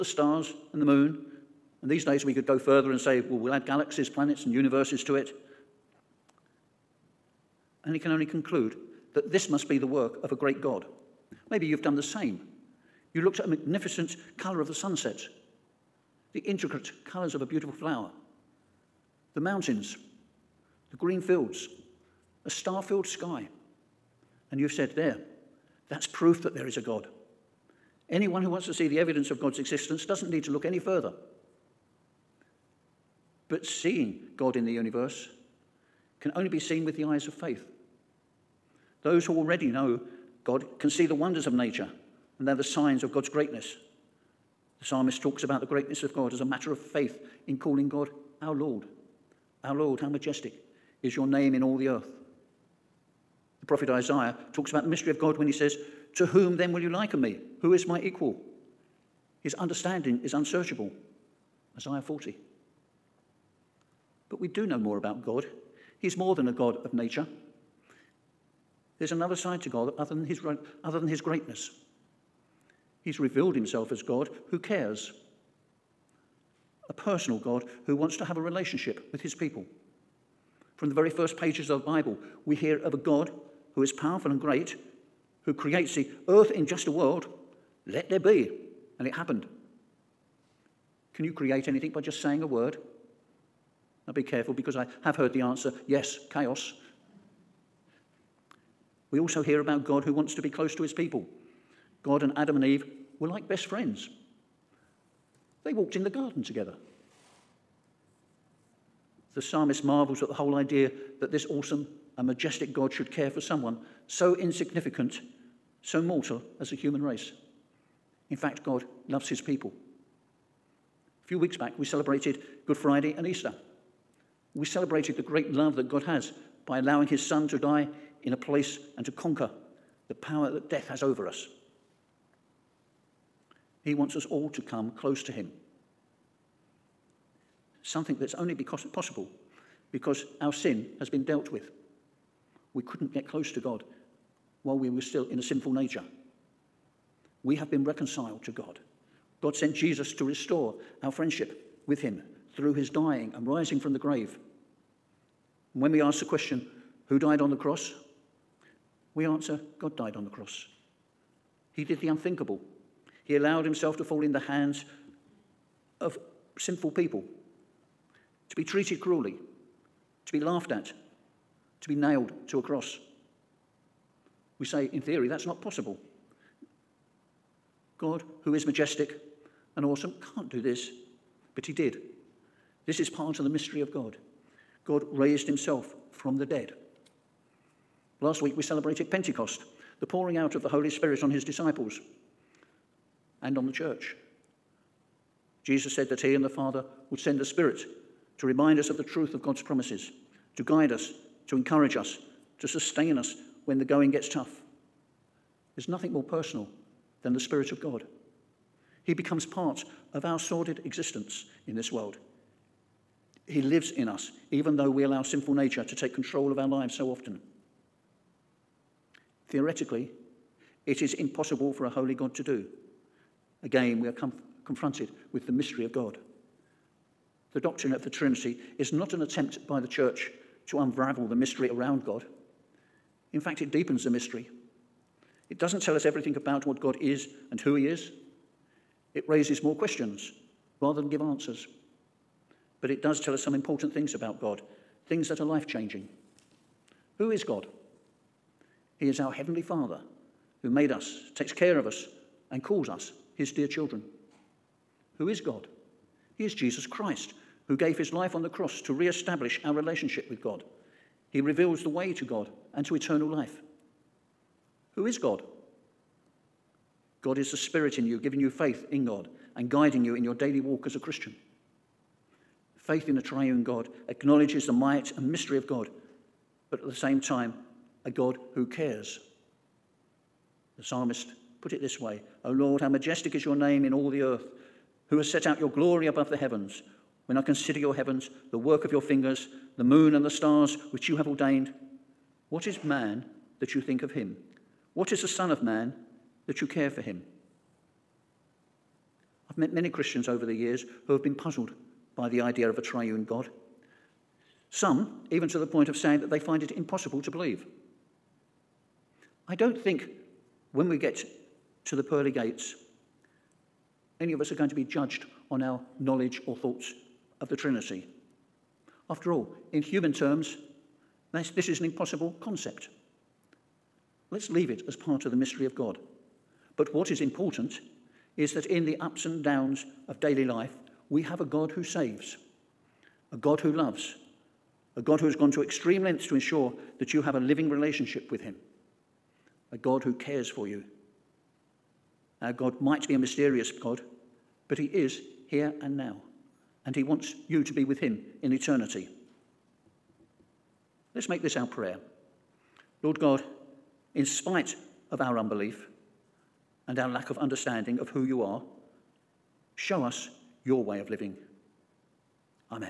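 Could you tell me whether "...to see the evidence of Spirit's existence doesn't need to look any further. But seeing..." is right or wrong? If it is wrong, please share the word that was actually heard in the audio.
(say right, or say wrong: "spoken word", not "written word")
wrong: "God", not "Spirit".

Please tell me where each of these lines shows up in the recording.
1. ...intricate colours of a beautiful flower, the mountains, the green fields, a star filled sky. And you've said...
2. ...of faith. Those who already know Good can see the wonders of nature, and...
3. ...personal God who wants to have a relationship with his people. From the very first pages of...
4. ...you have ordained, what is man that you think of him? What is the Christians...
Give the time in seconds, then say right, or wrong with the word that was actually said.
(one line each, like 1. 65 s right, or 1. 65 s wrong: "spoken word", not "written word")
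1. 16 s right
2. 37 s wrong: "God", not "Good"
3. 76 s right
4. 291 s wrong: "Son", not "Christians".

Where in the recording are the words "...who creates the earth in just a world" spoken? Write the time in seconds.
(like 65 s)
85 s.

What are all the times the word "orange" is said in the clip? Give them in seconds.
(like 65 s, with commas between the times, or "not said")
not said.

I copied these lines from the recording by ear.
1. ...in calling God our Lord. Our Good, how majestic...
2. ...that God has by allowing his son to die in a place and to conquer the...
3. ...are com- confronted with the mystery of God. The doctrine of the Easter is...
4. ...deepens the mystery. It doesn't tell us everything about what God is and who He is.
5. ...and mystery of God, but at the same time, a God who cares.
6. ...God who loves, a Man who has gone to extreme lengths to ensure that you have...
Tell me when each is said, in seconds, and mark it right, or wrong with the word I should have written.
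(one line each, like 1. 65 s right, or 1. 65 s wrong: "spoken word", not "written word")
1. 47 s wrong: "Lord", not "Good"
2. 125 s right
3. 224 s wrong: "Trinity", not "Easter"
4. 233 s right
5. 275 s right
6. 333 s wrong: "God", not "Man".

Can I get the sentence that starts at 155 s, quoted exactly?
And when we ask the question, who died on the cross?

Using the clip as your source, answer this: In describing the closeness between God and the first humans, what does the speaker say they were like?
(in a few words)
Best friends.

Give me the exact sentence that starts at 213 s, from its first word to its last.
He lives in us, even though we allow sinful nature to take control of our lives so often.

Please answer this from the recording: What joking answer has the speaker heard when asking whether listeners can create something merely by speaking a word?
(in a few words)
Chaos.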